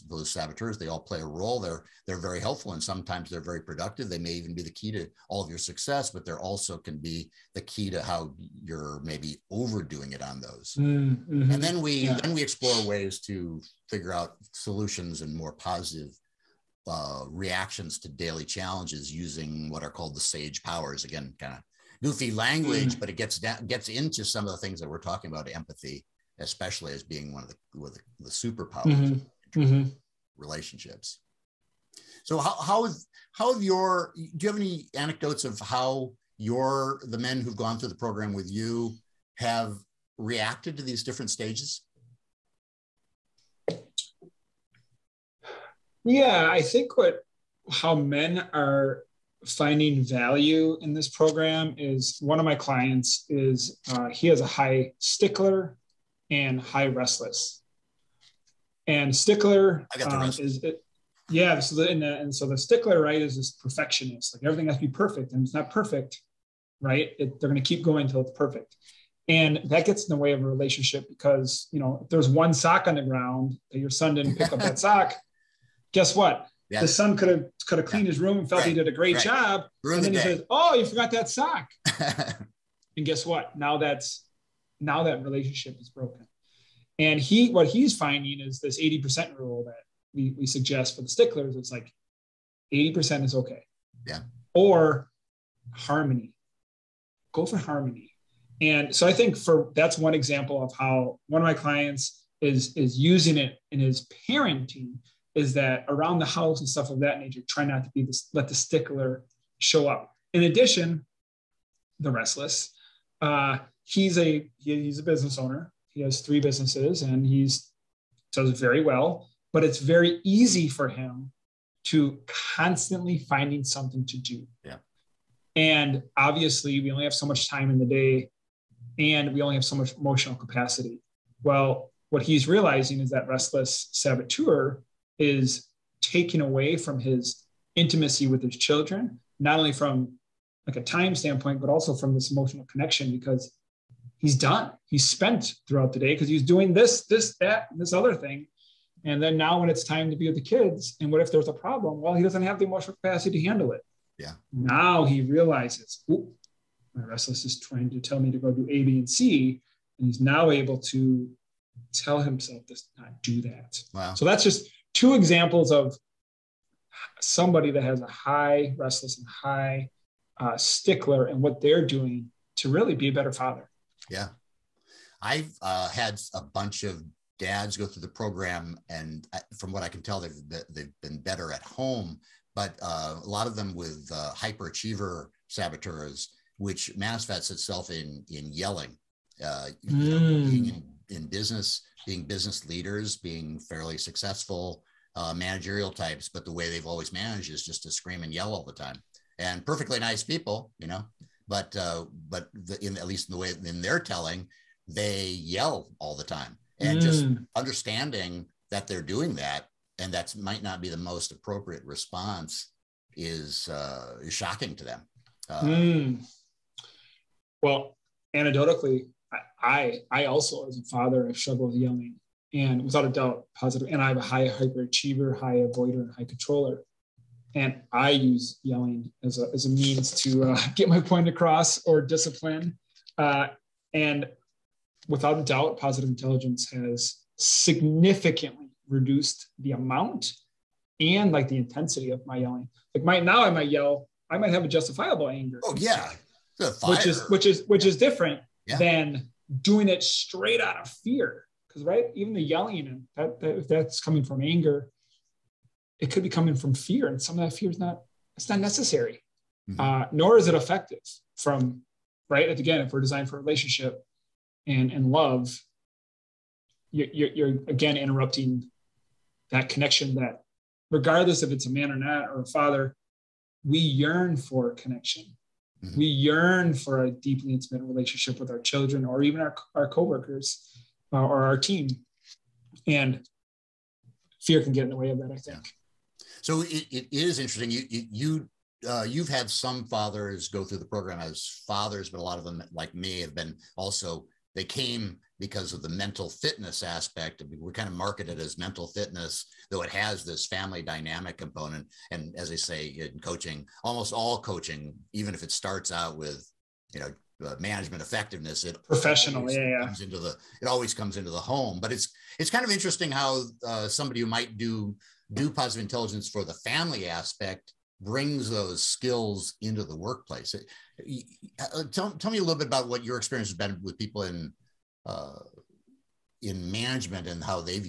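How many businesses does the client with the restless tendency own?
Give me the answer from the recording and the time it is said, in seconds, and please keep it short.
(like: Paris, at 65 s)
3, at 116 s.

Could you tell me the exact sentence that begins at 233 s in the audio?
Uh, and without a doubt, positive intelligence has significantly reduced the amount and like the intensity of my yelling.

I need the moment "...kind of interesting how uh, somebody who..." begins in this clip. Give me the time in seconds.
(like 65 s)
312 s.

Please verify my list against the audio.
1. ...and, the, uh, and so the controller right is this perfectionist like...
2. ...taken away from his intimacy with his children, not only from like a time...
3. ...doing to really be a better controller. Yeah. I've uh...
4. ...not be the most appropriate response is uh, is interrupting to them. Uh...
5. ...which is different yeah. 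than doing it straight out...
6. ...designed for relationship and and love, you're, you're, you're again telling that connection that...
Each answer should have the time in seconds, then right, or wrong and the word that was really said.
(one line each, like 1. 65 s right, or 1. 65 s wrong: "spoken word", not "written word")
1. 61 s wrong: "stickler", not "controller"
2. 136 s right
3. 171 s wrong: "father", not "controller"
4. 210 s wrong: "shocking", not "interrupting"
5. 247 s right
6. 263 s wrong: "interrupting", not "telling".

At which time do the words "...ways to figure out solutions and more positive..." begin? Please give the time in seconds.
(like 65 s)
12 s.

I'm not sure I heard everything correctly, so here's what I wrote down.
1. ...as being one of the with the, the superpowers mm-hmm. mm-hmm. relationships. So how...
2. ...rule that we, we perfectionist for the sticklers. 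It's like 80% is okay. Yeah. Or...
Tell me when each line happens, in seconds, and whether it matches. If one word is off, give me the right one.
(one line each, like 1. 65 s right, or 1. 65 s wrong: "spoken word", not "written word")
1. 26 s right
2. 89 s wrong: "suggest", not "perfectionist".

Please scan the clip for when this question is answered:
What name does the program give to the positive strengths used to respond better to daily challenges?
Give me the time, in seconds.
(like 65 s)
20 s.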